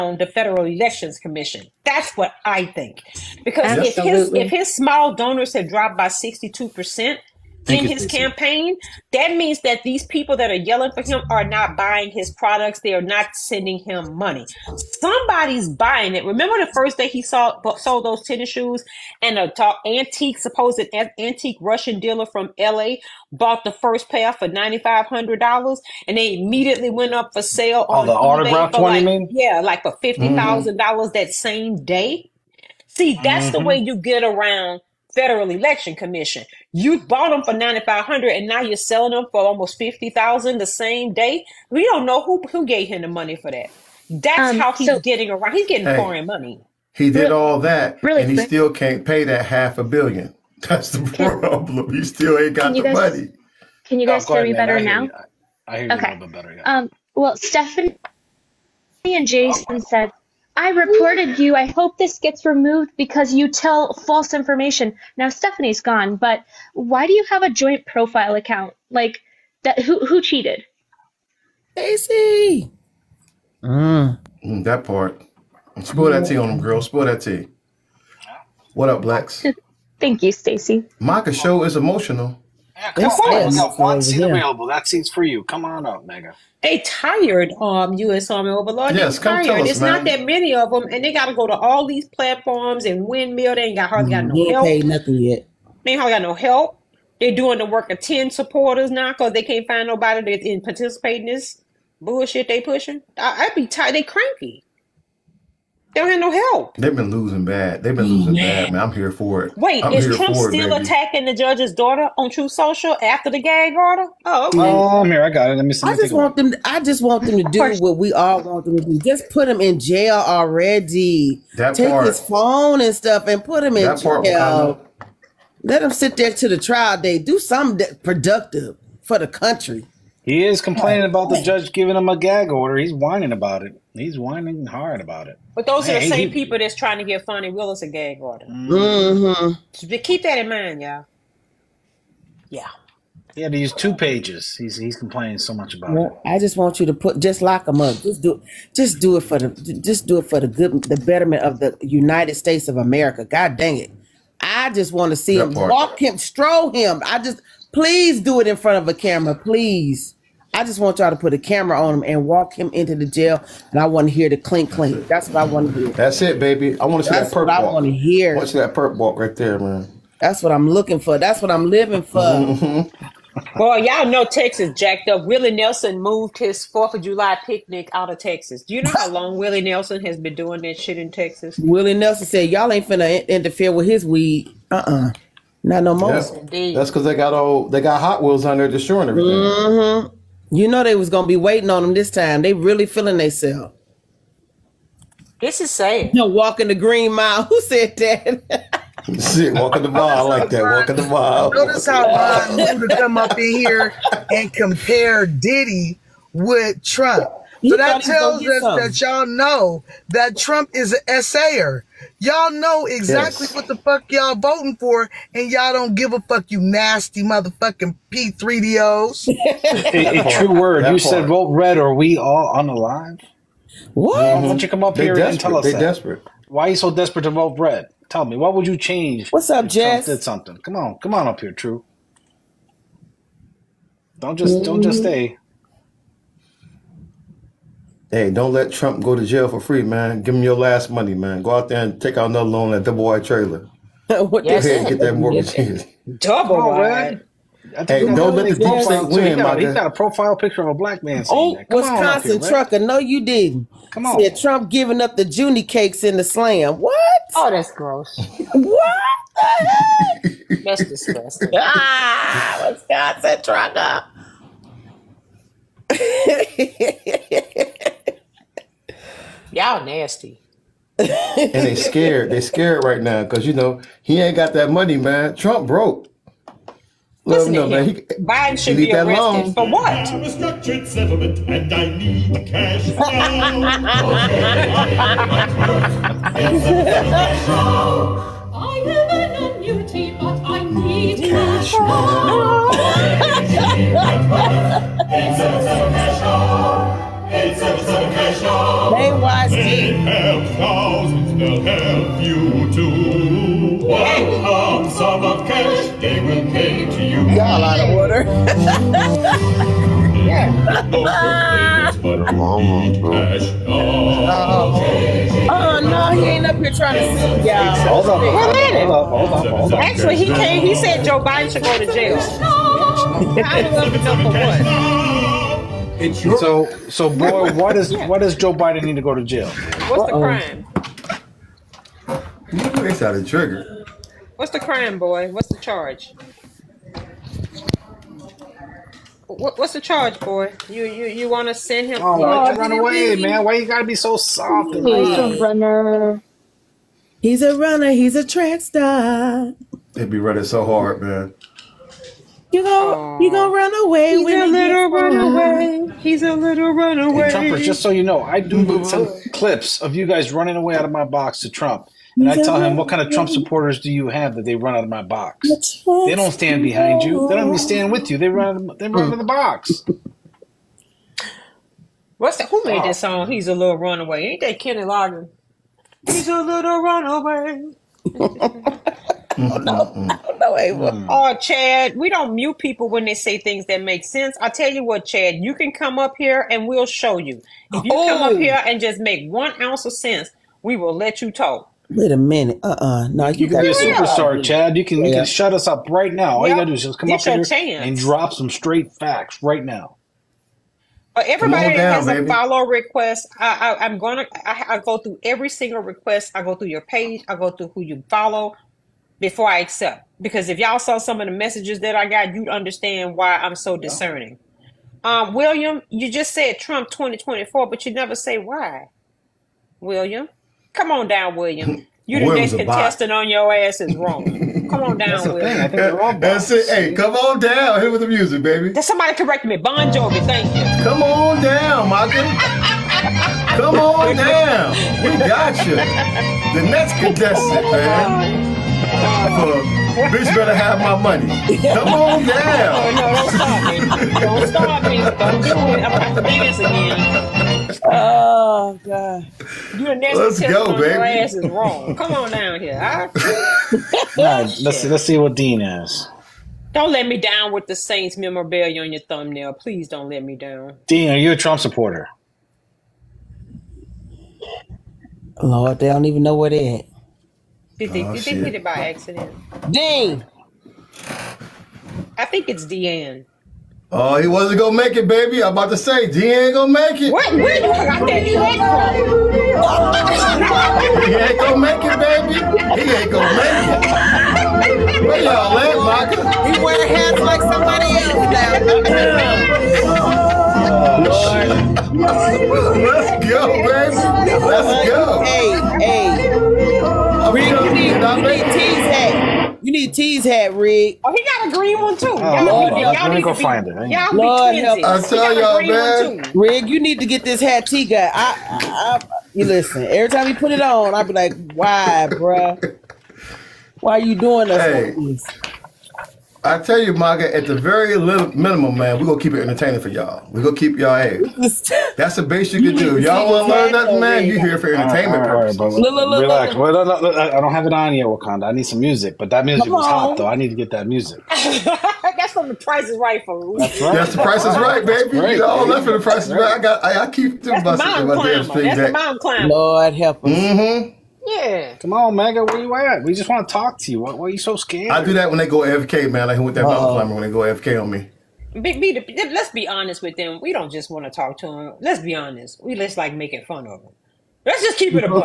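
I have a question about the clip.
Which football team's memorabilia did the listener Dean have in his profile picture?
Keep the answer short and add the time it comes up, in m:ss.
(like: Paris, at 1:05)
Saints, at 7:37.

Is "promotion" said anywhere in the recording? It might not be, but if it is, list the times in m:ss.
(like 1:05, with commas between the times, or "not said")
not said.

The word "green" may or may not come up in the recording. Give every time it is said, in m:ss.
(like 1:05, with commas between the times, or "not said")
3:16, 8:21.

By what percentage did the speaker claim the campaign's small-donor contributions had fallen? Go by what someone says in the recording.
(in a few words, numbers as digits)
62%.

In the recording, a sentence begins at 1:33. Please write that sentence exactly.
They ain't got hardly got mm-hmm.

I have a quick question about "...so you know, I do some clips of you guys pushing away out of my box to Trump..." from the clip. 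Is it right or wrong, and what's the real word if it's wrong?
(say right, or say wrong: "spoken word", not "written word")
wrong: "running", not "pushing".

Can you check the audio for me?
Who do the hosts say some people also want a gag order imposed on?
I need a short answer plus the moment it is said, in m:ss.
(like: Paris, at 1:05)
Fani Willis, at 2:17.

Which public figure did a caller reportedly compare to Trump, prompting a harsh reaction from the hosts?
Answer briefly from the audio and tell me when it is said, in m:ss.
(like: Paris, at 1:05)
Diddy, at 3:25.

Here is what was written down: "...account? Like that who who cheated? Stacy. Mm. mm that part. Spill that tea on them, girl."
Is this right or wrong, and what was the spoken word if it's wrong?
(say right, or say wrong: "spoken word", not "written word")
right.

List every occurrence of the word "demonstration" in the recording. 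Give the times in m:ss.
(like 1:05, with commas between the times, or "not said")
not said.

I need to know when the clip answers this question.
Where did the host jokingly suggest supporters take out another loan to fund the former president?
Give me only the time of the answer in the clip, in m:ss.
4:02.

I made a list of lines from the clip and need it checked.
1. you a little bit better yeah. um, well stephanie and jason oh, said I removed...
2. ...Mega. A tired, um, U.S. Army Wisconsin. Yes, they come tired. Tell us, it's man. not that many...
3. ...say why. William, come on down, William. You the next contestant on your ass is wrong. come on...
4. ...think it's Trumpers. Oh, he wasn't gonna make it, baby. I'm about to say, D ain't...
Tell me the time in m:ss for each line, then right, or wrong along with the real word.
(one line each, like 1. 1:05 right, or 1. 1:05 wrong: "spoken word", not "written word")
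1. 0:56 wrong: "reported", not "removed"
2. 1:26 wrong: "Overlord", not "Wisconsin"
3. 6:58 right
4. 7:52 wrong: "Deanne", not "Trumpers".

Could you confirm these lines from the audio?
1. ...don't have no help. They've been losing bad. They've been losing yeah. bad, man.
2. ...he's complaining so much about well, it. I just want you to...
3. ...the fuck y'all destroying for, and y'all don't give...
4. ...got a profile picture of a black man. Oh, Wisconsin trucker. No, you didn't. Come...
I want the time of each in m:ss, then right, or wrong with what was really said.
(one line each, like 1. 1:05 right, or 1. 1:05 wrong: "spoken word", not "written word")
1. 1:46 right
2. 2:24 right
3. 3:33 wrong: "voting", not "destroying"
4. 4:09 right.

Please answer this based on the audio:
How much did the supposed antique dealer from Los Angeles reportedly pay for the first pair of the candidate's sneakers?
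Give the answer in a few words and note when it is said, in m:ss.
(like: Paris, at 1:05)
$9,500, at 0:24.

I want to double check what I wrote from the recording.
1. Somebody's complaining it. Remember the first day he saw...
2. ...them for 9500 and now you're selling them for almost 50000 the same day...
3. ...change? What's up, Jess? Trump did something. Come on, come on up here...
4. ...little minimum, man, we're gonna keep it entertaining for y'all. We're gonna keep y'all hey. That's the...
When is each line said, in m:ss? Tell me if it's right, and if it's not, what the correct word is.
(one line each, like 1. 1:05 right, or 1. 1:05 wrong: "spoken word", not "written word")
1. 0:14 wrong: "buying", not "complaining"
2. 0:37 right
3. 3:48 right
4. 8:37 right.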